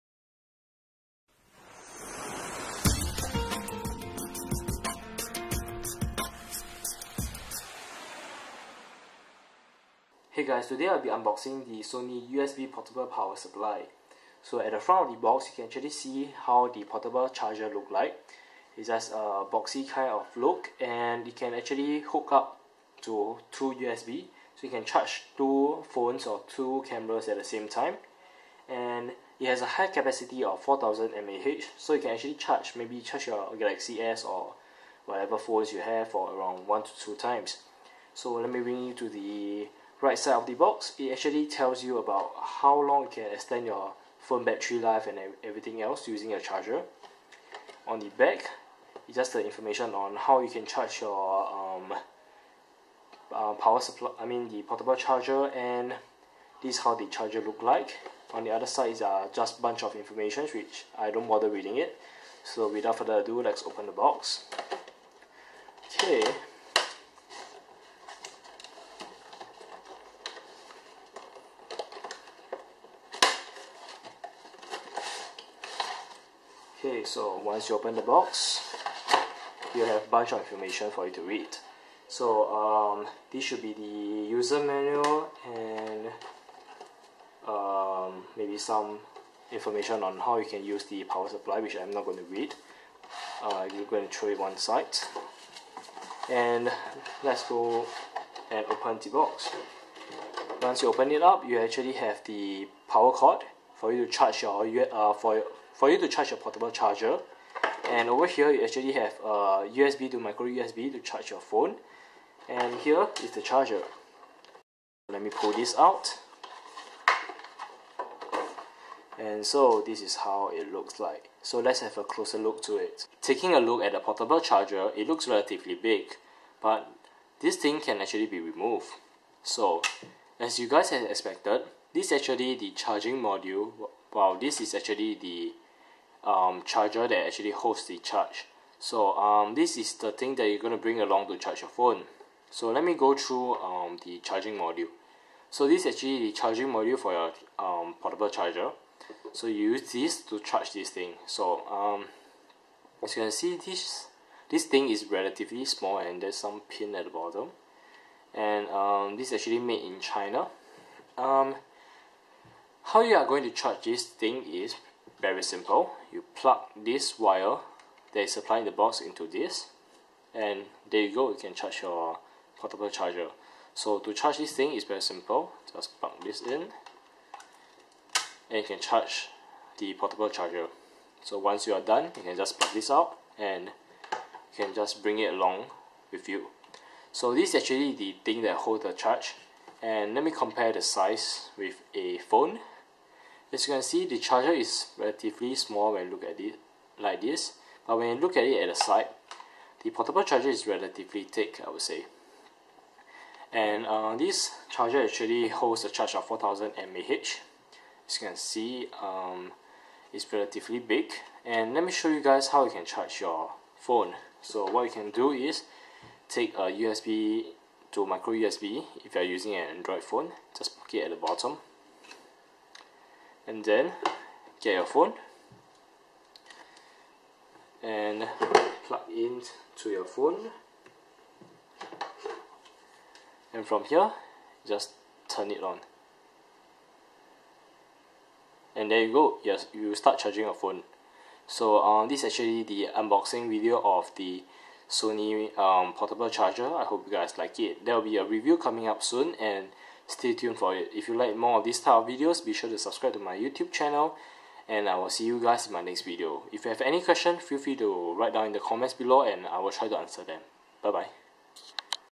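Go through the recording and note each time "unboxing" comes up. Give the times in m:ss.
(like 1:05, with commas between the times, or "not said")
0:11, 4:02.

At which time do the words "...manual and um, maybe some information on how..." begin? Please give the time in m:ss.
1:24.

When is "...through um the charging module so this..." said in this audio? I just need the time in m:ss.
2:23.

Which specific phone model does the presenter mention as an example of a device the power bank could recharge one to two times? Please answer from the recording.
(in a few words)
Galaxy S.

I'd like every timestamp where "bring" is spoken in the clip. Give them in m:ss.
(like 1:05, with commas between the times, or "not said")
0:38, 2:20, 3:05.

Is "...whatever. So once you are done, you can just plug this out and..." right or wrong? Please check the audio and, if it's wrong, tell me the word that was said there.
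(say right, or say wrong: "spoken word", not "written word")
wrong: "charger", not "whatever".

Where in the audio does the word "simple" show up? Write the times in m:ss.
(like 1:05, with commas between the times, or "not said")
2:45, 2:55.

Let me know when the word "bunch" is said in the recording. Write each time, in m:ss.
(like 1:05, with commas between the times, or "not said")
0:59, 1:20.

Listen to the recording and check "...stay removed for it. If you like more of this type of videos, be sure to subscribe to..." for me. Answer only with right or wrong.
wrong.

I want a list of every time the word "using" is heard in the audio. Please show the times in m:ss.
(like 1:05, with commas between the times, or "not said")
0:46, 3:39.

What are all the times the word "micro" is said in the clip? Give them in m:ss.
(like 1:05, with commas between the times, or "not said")
1:50, 3:38.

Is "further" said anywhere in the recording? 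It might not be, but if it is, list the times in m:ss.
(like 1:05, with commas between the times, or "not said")
1:02.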